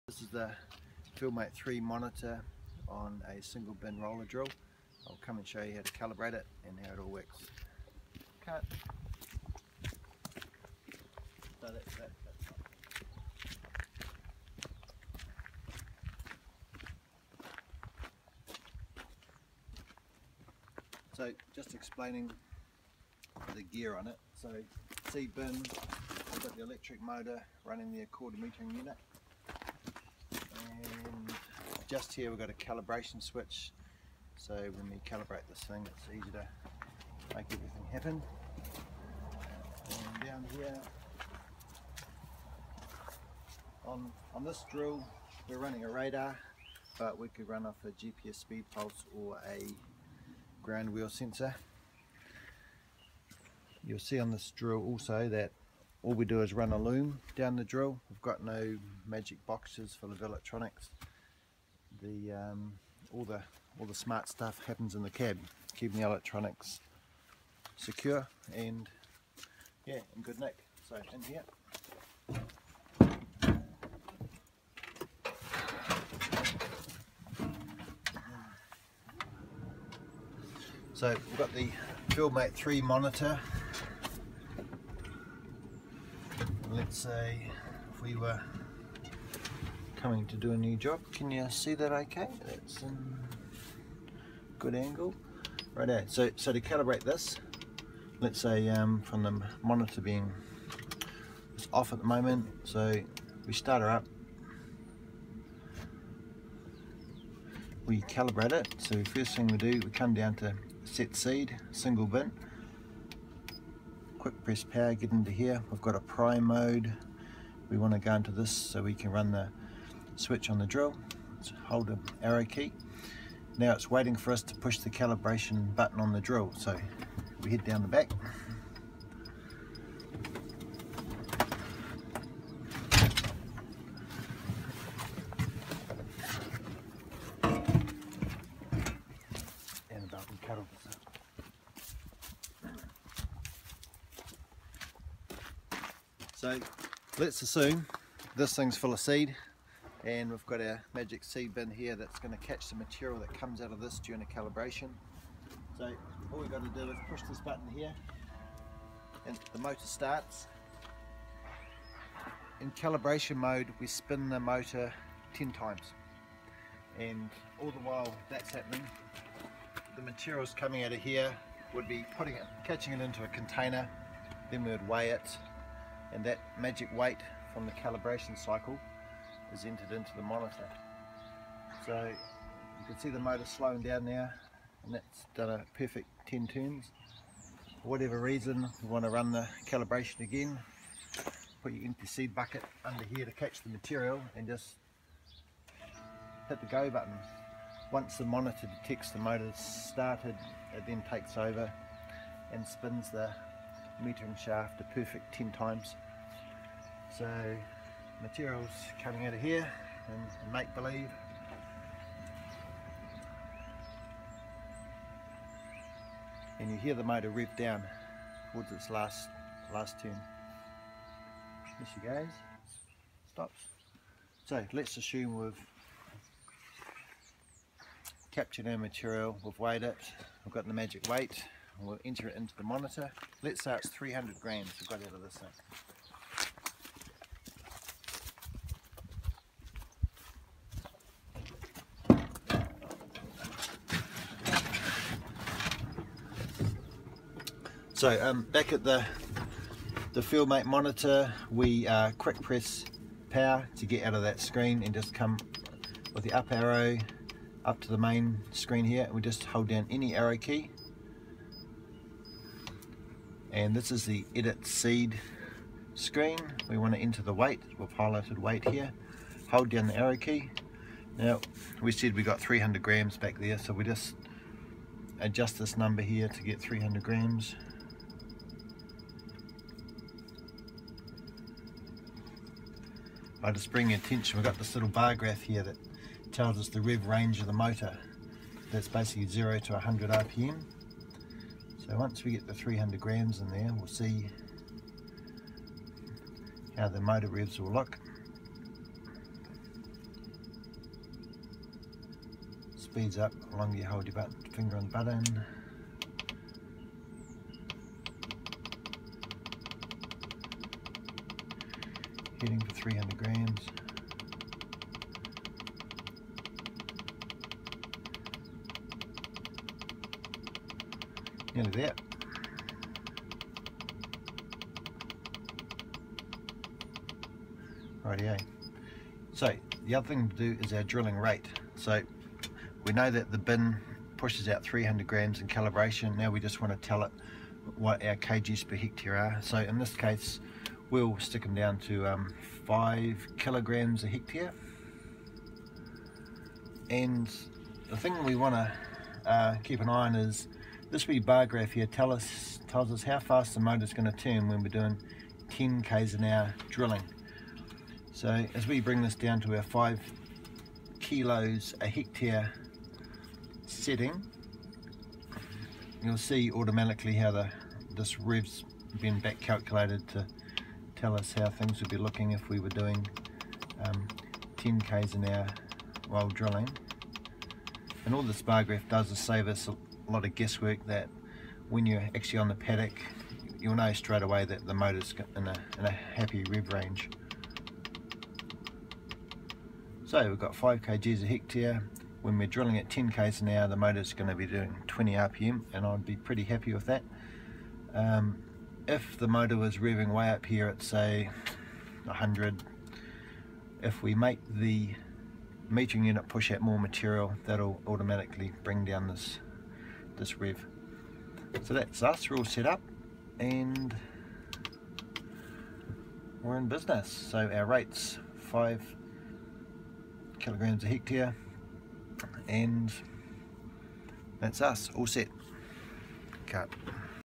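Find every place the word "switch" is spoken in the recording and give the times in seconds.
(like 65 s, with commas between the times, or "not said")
33 s, 120 s.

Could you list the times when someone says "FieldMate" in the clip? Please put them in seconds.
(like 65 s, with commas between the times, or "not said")
1 s, 82 s, 250 s.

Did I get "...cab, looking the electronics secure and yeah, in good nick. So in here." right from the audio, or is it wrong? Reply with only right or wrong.
wrong.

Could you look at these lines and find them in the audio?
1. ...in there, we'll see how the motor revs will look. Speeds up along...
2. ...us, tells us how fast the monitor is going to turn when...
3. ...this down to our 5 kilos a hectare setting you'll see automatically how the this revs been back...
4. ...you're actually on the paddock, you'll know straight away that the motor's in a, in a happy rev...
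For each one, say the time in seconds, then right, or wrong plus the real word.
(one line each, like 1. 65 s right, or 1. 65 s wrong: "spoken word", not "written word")
1. 293 s right
2. 352 s wrong: "motor", not "monitor"
3. 359 s right
4. 381 s right.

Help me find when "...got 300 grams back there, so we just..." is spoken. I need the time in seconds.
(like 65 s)
272 s.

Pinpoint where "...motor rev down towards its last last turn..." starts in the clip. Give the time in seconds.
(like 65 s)
217 s.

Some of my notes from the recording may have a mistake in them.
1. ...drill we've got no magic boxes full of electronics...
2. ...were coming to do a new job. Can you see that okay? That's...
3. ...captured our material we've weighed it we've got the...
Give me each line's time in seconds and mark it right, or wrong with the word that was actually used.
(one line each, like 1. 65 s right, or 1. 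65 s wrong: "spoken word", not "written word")
1. 57 s right
2. 88 s right
3. 228 s right.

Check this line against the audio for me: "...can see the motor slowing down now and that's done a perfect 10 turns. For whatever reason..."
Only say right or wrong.
right.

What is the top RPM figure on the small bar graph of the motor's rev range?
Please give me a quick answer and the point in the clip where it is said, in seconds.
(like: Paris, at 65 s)
100 RPM, at 289 s.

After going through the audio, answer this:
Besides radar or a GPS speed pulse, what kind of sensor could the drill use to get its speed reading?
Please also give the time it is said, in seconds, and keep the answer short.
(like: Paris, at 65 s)
ground wheel sensor, at 50 s.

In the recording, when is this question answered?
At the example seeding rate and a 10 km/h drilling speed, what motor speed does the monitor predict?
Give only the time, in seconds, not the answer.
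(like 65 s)
394 s.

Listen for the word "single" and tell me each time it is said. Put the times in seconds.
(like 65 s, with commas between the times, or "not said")
3 s, 111 s.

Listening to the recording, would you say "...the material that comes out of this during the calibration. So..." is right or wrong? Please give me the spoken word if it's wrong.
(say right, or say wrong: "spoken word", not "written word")
right.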